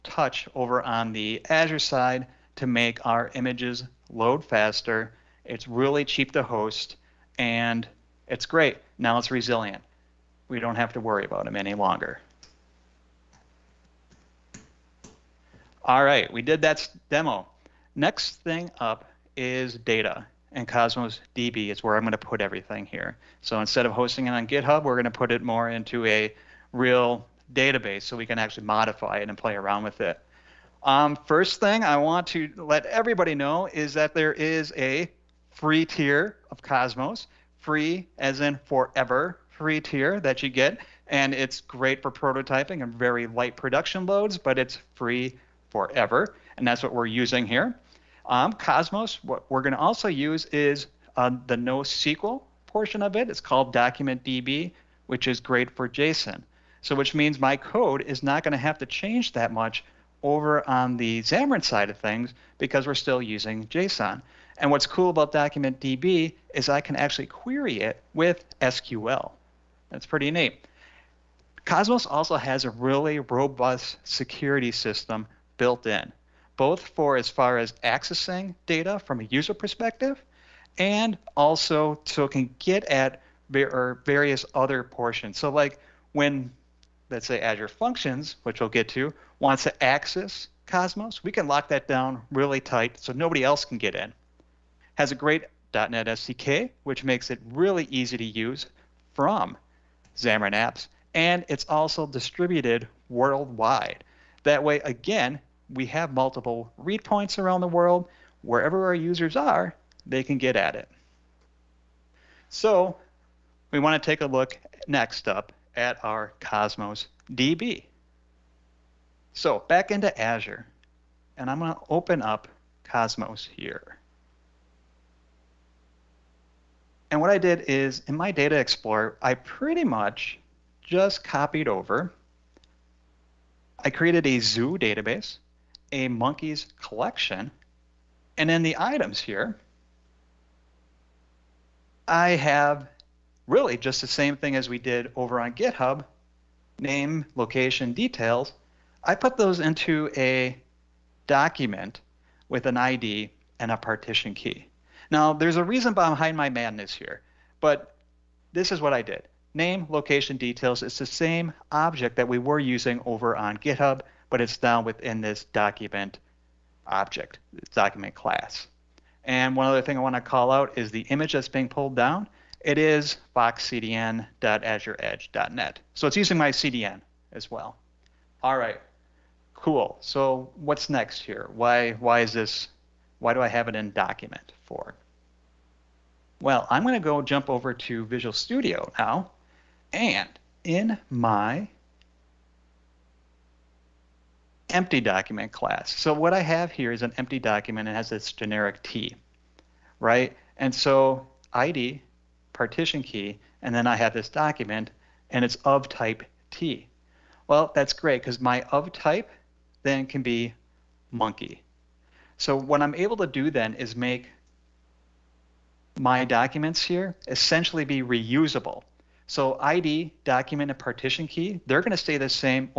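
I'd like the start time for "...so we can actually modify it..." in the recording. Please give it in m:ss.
0:28.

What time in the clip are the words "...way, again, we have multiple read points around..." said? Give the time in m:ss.
1:44.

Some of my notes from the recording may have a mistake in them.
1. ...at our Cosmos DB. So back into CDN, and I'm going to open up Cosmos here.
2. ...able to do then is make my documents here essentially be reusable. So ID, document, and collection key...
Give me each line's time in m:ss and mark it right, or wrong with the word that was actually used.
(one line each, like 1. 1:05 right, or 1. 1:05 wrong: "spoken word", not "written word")
1. 1:55 wrong: "Azure", not "CDN"
2. 3:32 wrong: "partition", not "collection".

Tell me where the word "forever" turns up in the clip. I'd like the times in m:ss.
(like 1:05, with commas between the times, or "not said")
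0:38, 0:45.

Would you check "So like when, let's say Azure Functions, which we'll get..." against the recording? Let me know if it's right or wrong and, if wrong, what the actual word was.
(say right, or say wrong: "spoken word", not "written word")
right.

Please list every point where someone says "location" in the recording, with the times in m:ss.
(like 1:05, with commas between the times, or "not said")
2:27, 2:39.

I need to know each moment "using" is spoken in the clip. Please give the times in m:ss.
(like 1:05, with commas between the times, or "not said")
0:47, 1:03, 2:42, 2:56.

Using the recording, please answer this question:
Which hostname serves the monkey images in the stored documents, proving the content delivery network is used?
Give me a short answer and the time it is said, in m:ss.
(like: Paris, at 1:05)
foxcdn.azureedge.net, at 2:53.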